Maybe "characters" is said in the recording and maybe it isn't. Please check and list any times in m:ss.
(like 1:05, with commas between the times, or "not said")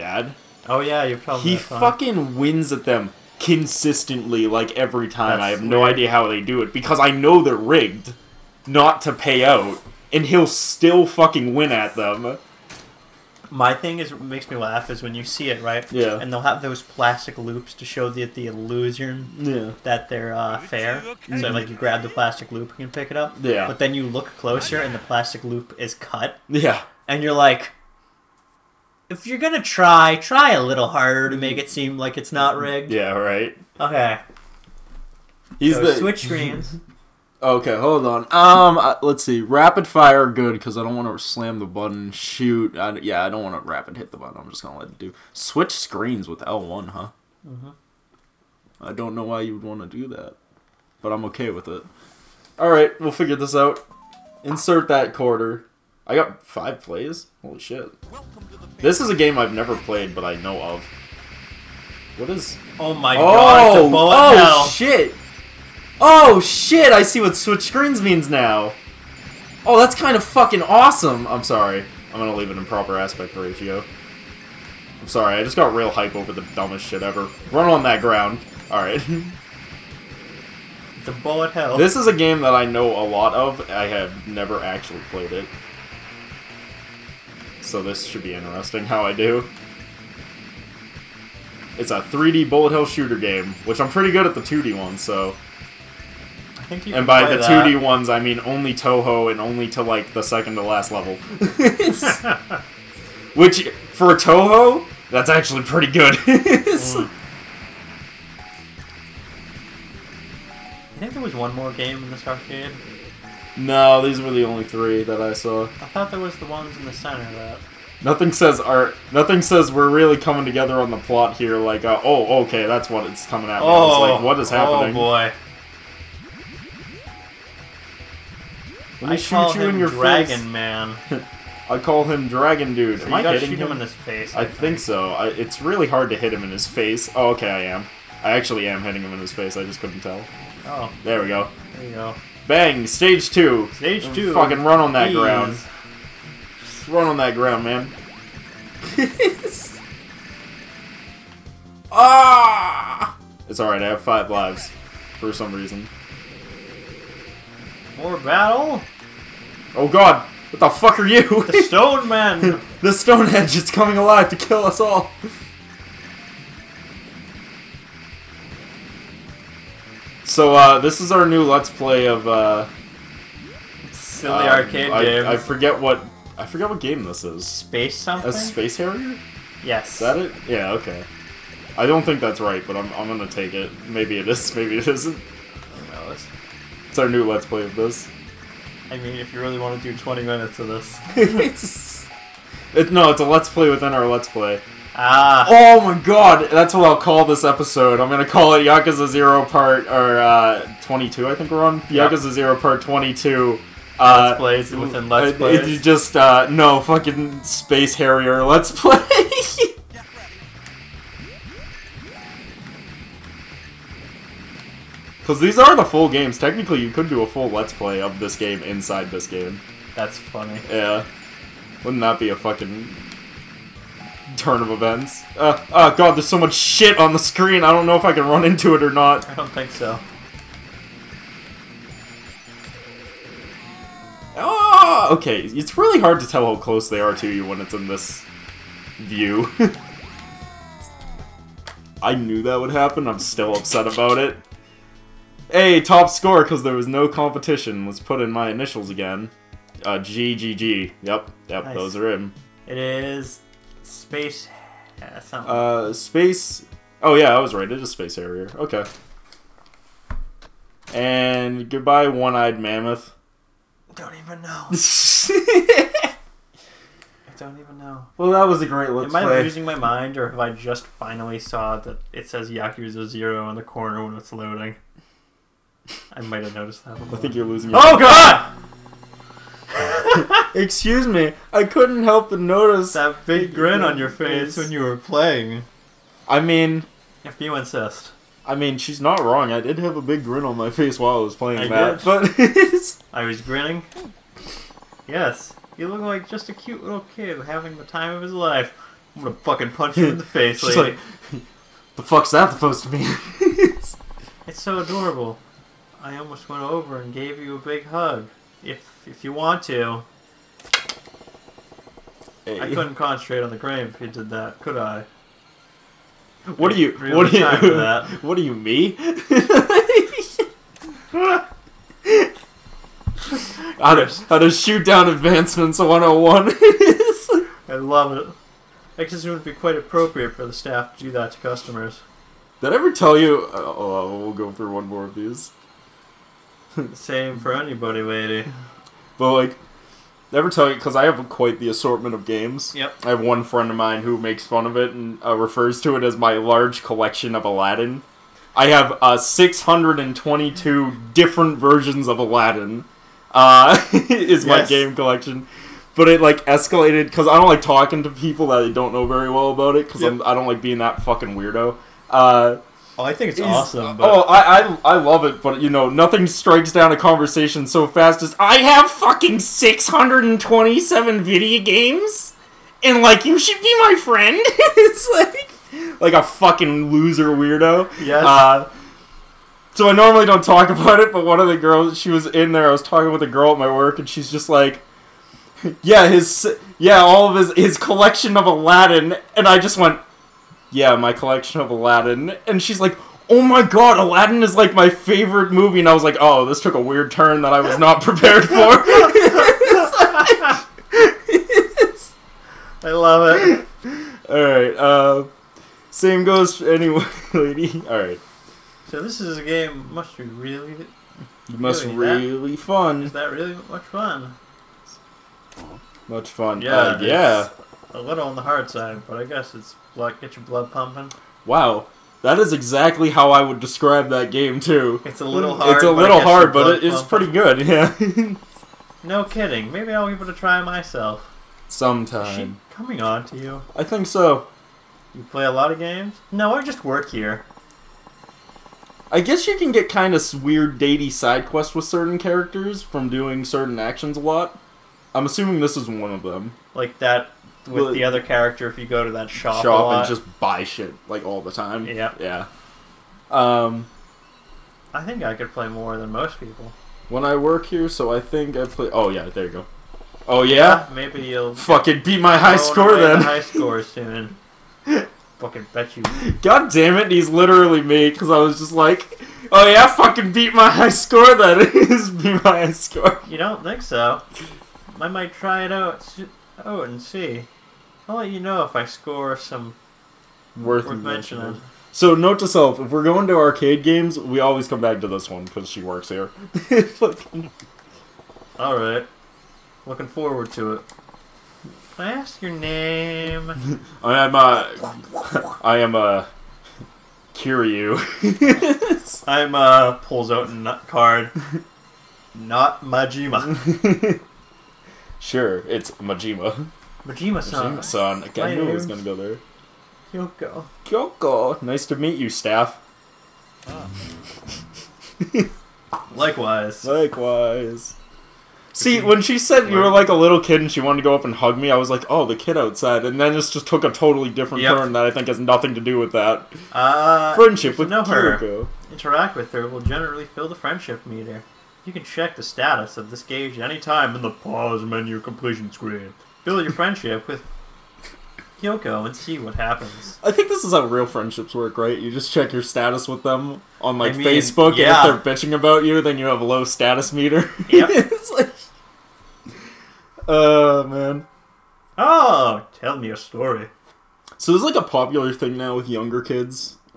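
7:22, 7:28.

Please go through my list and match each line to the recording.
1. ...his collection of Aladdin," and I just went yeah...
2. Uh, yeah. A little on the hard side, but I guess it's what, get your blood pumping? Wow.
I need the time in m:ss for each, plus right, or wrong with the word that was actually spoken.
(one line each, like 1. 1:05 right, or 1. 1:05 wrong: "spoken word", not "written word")
1. 6:27 right
2. 6:56 right.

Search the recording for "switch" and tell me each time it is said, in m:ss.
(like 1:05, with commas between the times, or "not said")
0:35, 0:45, 1:07.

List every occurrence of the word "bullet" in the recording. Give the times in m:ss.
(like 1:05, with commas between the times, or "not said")
1:21, 1:32.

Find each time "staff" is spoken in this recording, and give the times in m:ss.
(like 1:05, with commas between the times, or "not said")
5:30, 8:32.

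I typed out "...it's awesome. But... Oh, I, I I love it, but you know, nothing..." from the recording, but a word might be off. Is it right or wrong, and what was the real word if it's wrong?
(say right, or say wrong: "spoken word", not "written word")
right.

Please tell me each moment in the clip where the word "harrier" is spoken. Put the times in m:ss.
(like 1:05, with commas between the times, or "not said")
2:58, 3:27, 4:18.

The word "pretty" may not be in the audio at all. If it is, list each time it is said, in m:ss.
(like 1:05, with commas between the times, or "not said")
1:33, 1:45, 7:07.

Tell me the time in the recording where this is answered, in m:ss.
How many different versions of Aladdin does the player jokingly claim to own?
5:49.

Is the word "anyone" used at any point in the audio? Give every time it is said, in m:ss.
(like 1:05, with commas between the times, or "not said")
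6:46.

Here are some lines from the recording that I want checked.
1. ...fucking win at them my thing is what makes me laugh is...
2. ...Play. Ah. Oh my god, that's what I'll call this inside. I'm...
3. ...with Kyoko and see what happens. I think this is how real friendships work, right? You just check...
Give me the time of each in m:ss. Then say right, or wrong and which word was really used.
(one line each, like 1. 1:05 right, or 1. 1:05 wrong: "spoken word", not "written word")
1. 0:11 right
2. 3:14 wrong: "episode", not "inside"
3. 8:57 right.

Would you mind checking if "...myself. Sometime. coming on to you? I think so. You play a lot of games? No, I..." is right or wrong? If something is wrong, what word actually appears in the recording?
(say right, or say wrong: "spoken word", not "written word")
right.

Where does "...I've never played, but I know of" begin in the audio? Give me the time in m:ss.
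0:59.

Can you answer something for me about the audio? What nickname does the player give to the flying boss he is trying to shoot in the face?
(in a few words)
Dragon Dude.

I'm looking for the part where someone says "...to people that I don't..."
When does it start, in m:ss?
5:58.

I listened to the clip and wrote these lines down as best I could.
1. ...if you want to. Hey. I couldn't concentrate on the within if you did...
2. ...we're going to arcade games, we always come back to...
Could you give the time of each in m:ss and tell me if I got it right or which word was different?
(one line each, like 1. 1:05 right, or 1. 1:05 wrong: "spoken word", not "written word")
1. 5:09 wrong: "grain", not "within"
2. 8:02 right.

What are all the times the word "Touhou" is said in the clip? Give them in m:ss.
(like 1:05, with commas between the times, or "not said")
1:38, 1:44.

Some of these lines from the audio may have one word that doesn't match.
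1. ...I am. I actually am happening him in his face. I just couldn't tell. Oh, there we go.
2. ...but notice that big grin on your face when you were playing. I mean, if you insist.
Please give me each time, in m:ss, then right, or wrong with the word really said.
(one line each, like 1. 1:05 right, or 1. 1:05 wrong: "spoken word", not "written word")
1. 2:17 wrong: "hitting", not "happening"
2. 4:42 right.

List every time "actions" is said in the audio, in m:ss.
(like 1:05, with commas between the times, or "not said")
7:23.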